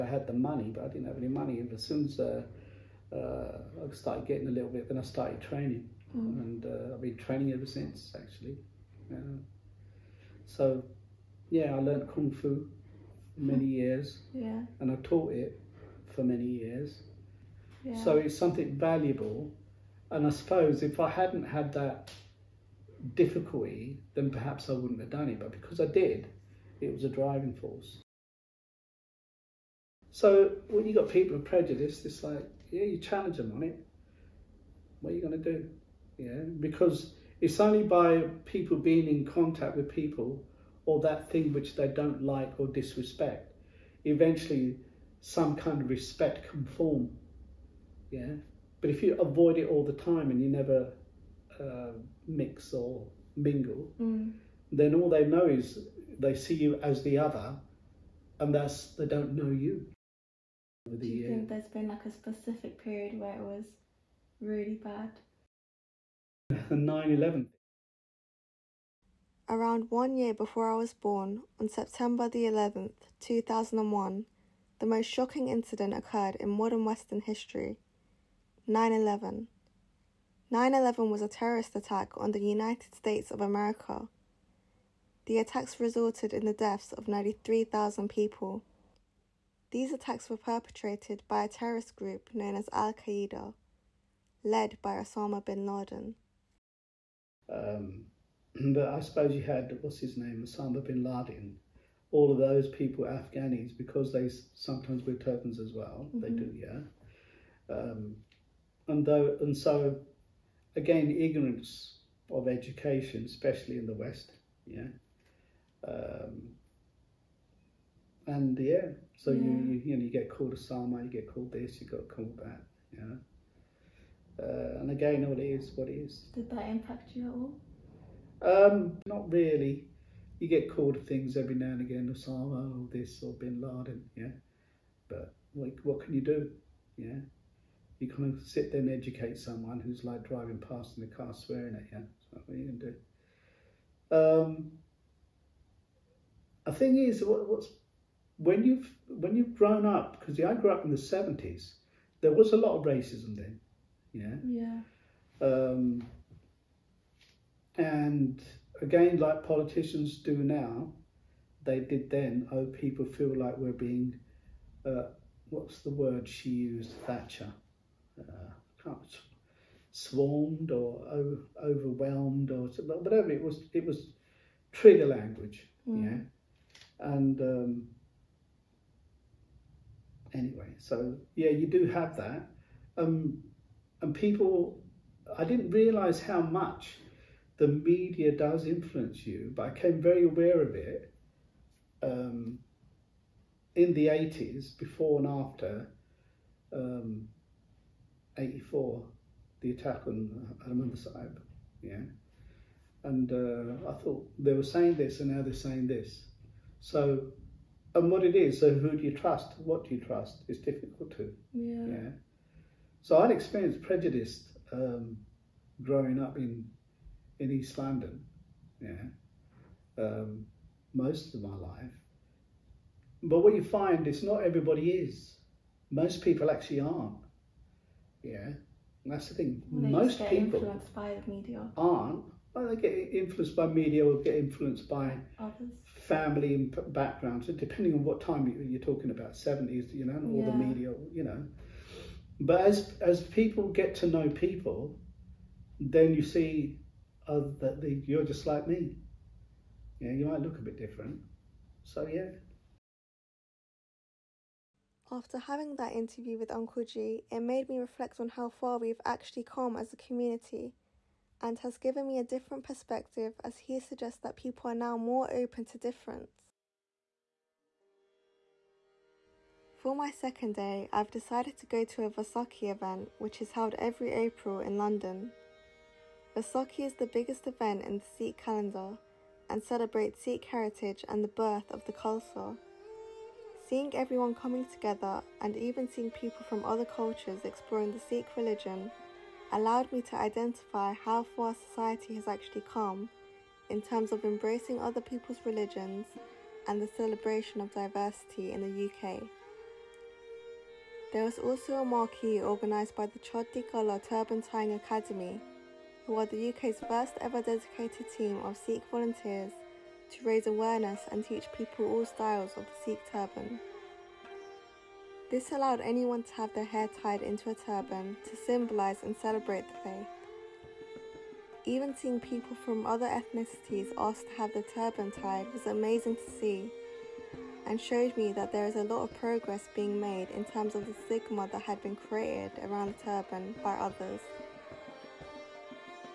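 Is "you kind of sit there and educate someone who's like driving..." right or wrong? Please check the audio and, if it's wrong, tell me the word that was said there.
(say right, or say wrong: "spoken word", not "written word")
right.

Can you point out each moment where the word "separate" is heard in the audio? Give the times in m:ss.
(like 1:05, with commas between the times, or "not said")
not said.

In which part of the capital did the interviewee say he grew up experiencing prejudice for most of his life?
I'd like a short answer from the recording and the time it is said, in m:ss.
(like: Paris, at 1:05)
East London, at 3:37.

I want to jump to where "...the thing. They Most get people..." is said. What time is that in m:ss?
3:49.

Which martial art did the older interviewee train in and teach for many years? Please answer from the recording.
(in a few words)
Kung fu.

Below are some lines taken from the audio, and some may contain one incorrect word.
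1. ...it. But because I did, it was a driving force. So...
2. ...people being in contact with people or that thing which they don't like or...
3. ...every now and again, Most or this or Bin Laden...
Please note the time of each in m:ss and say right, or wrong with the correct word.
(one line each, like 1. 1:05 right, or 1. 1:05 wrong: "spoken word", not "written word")
1. 0:25 right
2. 0:38 right
3. 2:11 wrong: "Osama", not "Most".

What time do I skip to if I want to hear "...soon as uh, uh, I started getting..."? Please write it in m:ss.
0:01.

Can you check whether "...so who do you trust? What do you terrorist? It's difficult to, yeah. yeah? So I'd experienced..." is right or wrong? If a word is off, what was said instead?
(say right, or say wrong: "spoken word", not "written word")
wrong: "trust", not "terrorist".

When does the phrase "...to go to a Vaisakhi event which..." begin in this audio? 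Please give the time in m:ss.
4:31.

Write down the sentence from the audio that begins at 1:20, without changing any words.
9 11 was a terrorist attack on the United States of America.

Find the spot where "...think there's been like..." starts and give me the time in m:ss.
1:01.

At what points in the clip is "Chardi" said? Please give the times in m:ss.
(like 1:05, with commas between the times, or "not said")
5:03.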